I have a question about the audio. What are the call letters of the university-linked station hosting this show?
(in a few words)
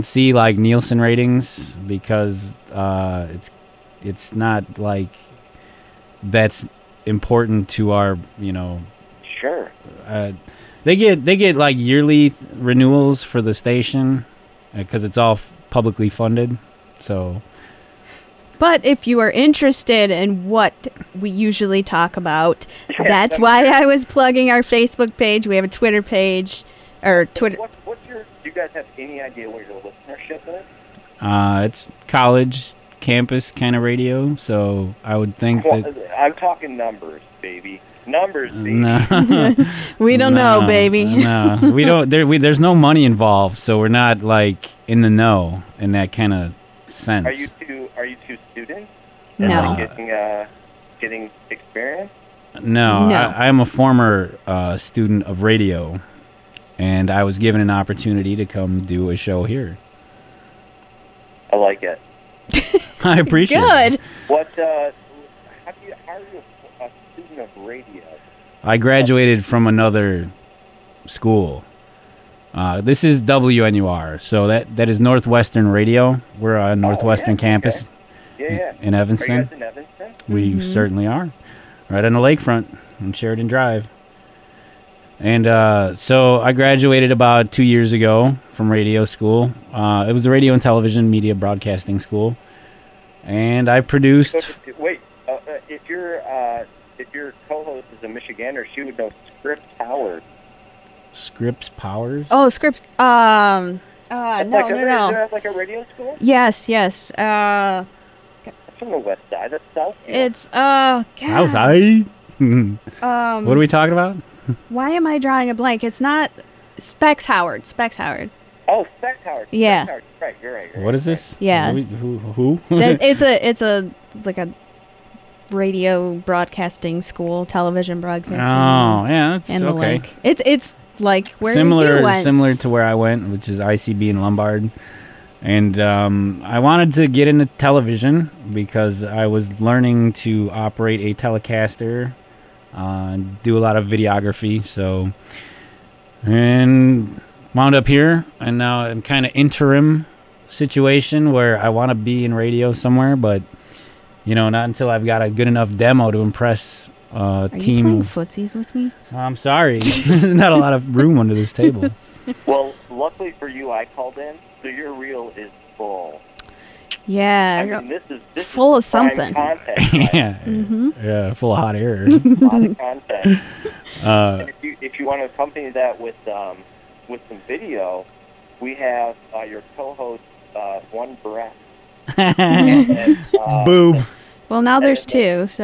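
WNUR.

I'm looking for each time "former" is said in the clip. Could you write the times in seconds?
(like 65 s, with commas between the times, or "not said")
53 s.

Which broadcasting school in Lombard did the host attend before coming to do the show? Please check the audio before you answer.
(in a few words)
ICB.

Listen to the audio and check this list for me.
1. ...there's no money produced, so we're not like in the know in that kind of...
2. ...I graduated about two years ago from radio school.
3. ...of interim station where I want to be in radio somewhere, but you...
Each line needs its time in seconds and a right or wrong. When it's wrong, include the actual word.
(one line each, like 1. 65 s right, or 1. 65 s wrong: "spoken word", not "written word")
1. 42 s wrong: "involved", not "produced"
2. 86 s right
3. 149 s wrong: "situation", not "station".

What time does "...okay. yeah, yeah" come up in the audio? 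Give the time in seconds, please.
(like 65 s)
78 s.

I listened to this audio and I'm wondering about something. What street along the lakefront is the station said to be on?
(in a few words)
Sheridan Drive.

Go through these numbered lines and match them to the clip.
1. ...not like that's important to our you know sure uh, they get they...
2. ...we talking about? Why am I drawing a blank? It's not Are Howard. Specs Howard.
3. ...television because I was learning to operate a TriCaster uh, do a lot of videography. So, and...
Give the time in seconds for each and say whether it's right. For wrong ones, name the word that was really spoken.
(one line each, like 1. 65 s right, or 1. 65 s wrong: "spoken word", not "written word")
1. 4 s right
2. 113 s wrong: "Specs", not "Are"
3. 137 s right.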